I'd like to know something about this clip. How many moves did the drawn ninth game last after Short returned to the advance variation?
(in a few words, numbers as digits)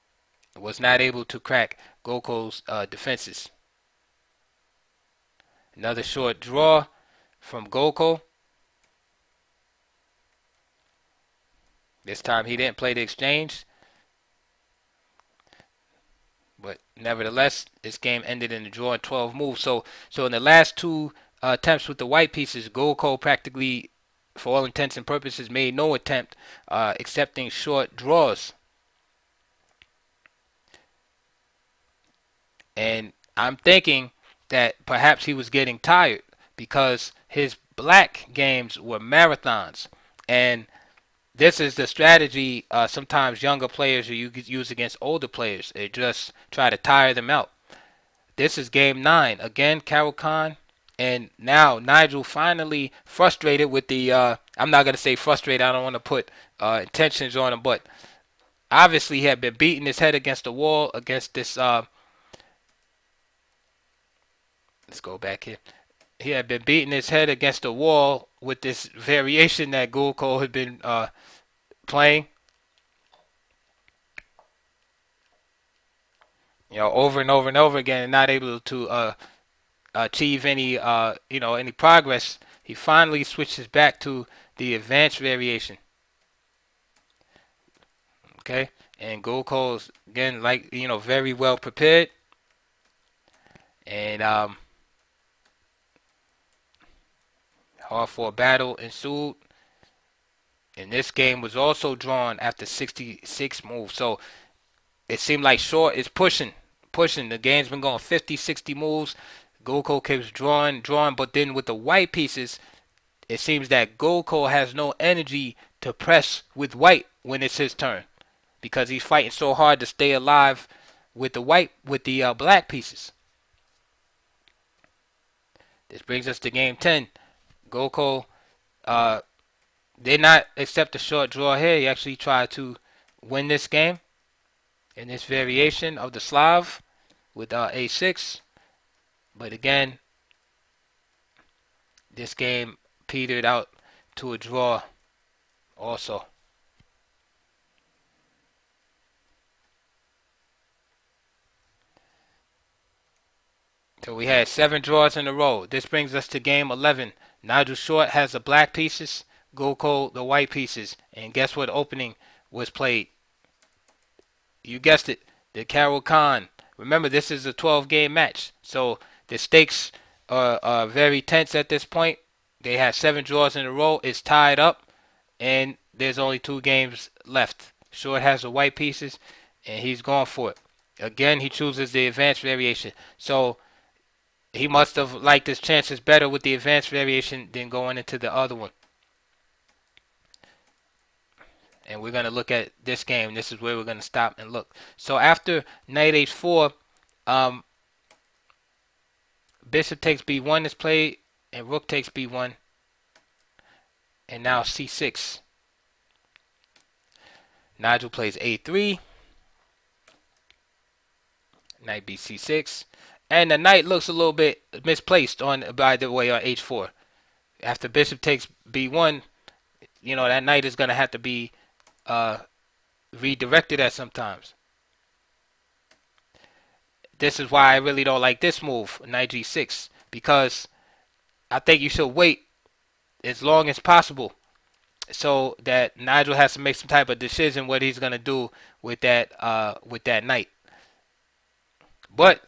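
66.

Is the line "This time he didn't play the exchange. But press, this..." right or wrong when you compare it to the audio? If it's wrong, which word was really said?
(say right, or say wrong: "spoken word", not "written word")
wrong: "nevertheless", not "press".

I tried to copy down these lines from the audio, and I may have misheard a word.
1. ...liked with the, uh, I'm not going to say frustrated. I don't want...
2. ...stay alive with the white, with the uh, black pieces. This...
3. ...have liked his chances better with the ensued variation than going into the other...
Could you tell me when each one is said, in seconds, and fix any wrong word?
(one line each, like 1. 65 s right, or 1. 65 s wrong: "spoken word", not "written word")
1. 53 s wrong: "frustrated", not "liked"
2. 119 s right
3. 184 s wrong: "advanced", not "ensued".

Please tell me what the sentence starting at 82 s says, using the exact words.
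He finally switches back to the advanced variation.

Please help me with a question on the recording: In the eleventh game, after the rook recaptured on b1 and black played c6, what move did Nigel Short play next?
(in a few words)
a3.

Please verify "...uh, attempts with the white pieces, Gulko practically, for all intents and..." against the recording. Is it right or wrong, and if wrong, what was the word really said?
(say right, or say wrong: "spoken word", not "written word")
right.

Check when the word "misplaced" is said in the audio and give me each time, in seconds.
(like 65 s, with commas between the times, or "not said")
214 s.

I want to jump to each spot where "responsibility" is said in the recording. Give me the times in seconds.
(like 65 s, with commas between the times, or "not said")
not said.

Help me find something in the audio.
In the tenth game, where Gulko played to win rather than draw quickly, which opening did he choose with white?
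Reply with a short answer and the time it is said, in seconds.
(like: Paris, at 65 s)
Slav, at 136 s.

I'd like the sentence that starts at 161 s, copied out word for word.
And guess what opening was played?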